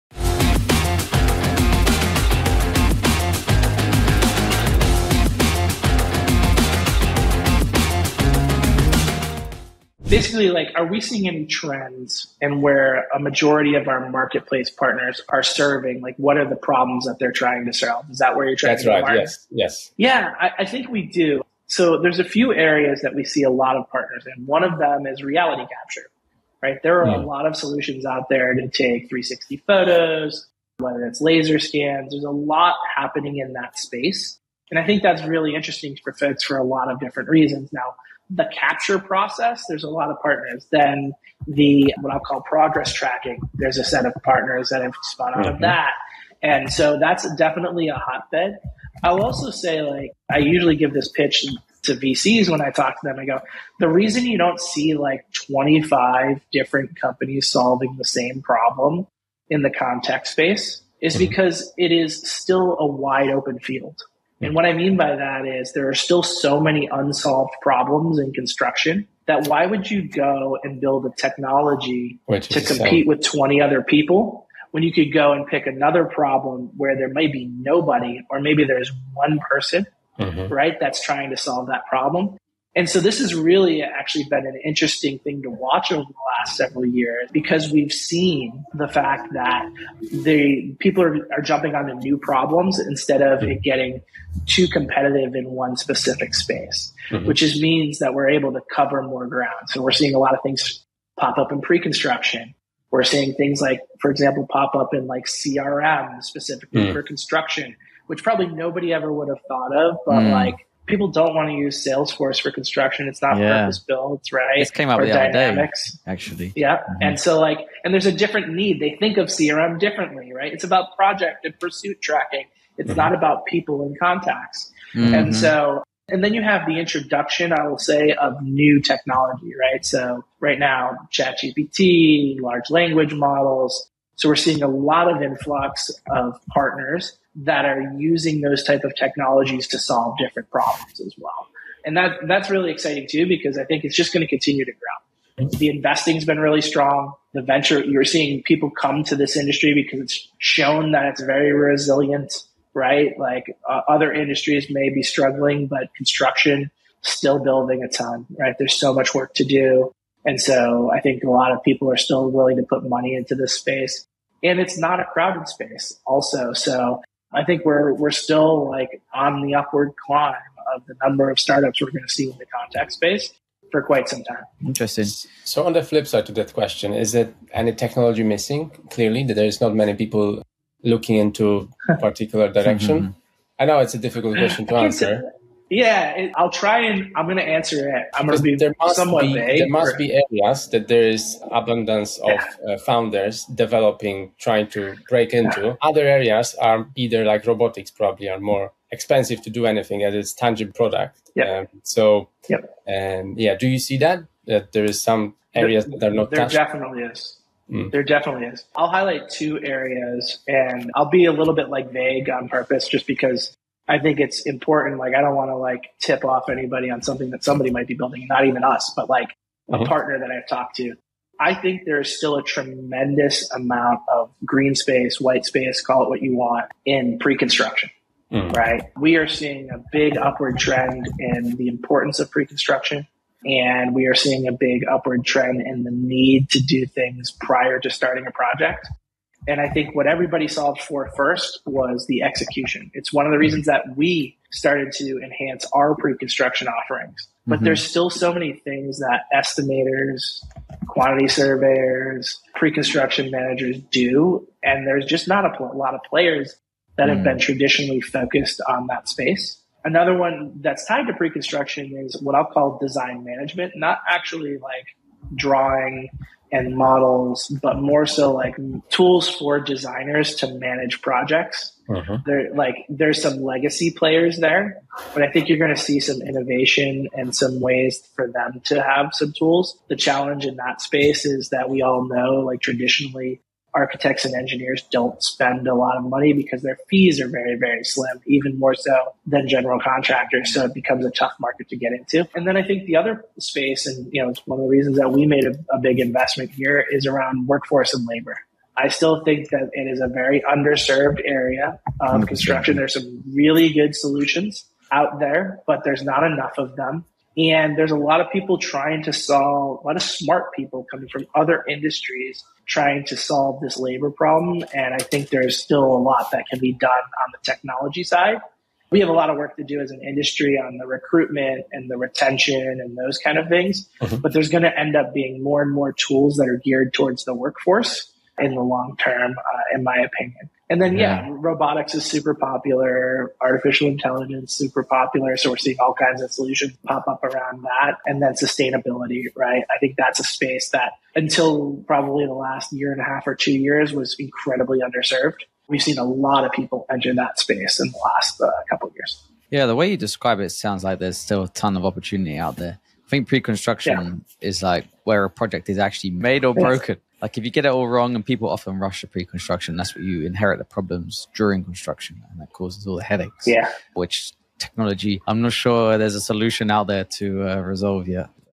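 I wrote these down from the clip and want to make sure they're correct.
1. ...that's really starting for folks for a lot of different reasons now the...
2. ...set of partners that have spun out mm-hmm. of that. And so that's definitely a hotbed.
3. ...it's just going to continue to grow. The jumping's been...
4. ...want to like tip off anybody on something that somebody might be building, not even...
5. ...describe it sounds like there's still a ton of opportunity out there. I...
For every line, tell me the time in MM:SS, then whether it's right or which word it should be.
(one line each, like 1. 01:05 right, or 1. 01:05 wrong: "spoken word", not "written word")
1. 00:35 wrong: "interesting", not "starting"
2. 00:43 right
3. 02:23 wrong: "investing", not "jumping"
4. 03:35 right
5. 05:49 right.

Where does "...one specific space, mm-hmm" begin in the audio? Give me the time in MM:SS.
01:35.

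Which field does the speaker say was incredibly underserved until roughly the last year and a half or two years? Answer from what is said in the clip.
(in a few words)
Sustainability.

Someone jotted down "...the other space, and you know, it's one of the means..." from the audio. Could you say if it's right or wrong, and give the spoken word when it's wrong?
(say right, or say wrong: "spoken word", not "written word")
wrong: "reasons", not "means".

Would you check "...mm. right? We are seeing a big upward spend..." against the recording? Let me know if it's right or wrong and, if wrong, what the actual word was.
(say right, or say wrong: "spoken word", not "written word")
wrong: "trend", not "spend".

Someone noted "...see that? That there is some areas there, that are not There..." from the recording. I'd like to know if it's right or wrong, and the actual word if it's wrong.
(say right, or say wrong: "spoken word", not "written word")
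right.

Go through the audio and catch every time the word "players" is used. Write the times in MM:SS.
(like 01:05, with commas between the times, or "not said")
04:16, 04:33.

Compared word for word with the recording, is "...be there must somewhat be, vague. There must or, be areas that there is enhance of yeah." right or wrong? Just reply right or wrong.
wrong.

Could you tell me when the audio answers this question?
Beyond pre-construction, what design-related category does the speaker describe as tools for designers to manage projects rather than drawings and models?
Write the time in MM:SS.
04:22.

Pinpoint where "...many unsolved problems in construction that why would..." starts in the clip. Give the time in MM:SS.
01:06.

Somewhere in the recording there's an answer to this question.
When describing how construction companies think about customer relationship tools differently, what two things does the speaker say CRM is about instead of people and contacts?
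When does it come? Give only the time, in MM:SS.
02:00.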